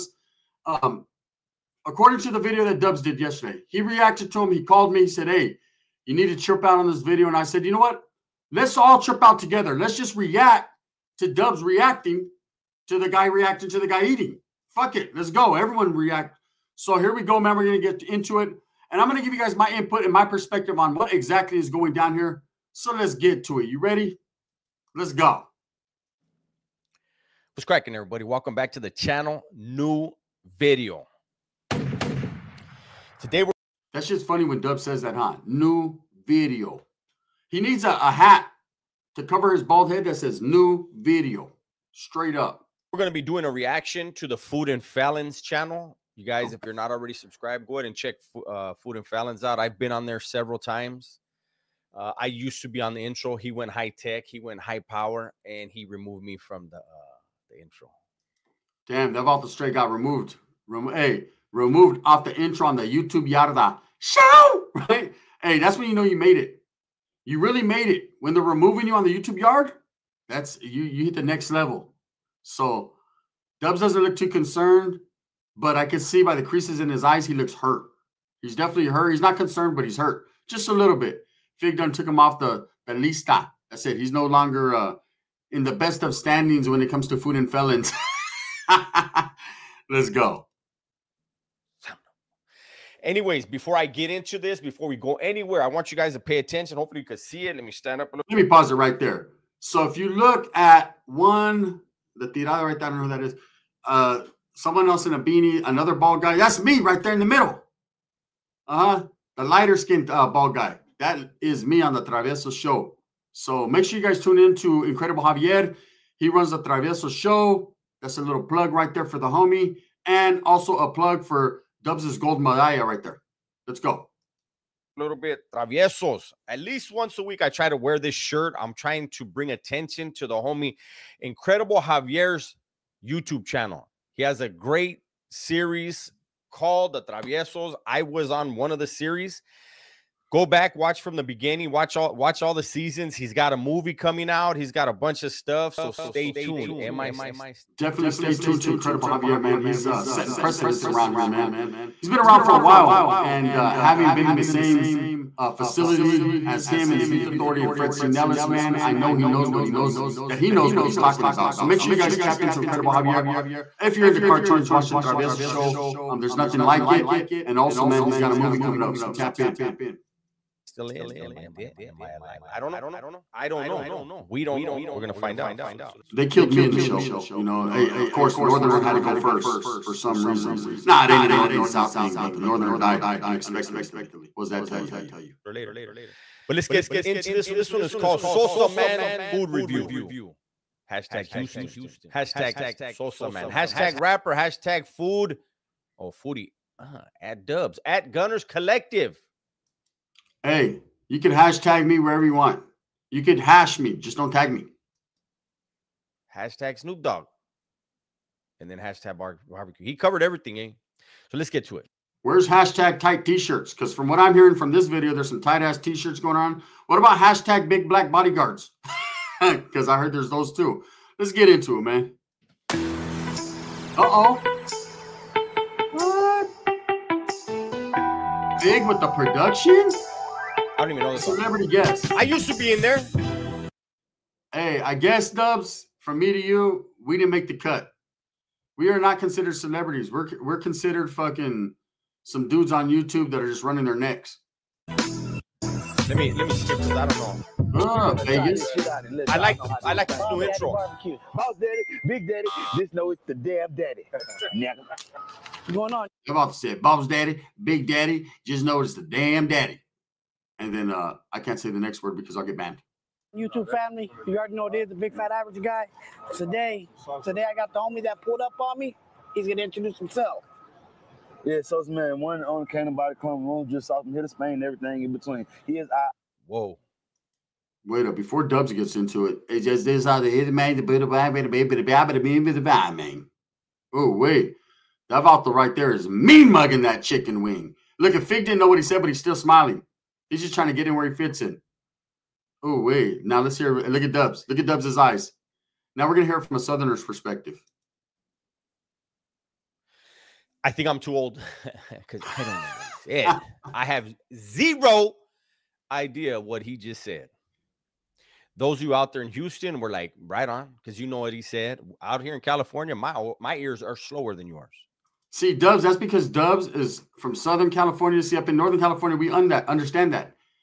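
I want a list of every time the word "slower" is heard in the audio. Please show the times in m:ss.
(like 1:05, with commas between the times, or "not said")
5:13.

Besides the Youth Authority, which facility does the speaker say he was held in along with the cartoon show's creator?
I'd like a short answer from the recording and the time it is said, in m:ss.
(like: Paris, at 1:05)
Fred C. Nelles, at 2:37.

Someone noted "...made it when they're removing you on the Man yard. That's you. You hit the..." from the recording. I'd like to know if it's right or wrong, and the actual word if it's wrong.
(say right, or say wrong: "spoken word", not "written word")
wrong: "YouTube", not "Man".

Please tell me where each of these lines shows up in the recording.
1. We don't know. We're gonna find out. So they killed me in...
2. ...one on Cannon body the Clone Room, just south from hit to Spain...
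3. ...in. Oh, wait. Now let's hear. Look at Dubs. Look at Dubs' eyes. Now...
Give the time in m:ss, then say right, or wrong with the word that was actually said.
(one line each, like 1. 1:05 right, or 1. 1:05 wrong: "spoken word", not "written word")
1. 2:54 right
2. 4:32 right
3. 4:51 right.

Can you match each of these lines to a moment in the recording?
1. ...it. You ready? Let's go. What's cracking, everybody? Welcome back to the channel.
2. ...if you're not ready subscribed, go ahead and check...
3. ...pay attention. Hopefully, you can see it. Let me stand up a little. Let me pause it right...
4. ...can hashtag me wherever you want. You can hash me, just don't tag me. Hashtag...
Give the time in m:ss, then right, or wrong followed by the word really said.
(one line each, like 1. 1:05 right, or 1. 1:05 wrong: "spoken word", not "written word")
1. 0:23 right
2. 0:46 wrong: "already", not "ready"
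3. 1:36 right
4. 3:21 right.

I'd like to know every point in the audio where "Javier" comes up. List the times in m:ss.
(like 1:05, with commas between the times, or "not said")
1:55, 2:11, 2:29, 2:42.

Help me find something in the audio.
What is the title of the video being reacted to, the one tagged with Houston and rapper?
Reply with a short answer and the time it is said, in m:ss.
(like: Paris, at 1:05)
Sosa Man Food Review, at 3:08.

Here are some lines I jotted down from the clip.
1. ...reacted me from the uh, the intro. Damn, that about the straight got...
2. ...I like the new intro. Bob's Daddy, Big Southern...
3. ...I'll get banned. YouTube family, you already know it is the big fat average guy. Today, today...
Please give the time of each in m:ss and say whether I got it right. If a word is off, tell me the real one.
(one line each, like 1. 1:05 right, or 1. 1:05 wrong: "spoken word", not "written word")
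1. 0:55 wrong: "removed", not "reacted"
2. 4:09 wrong: "Daddy", not "Southern"
3. 4:22 right.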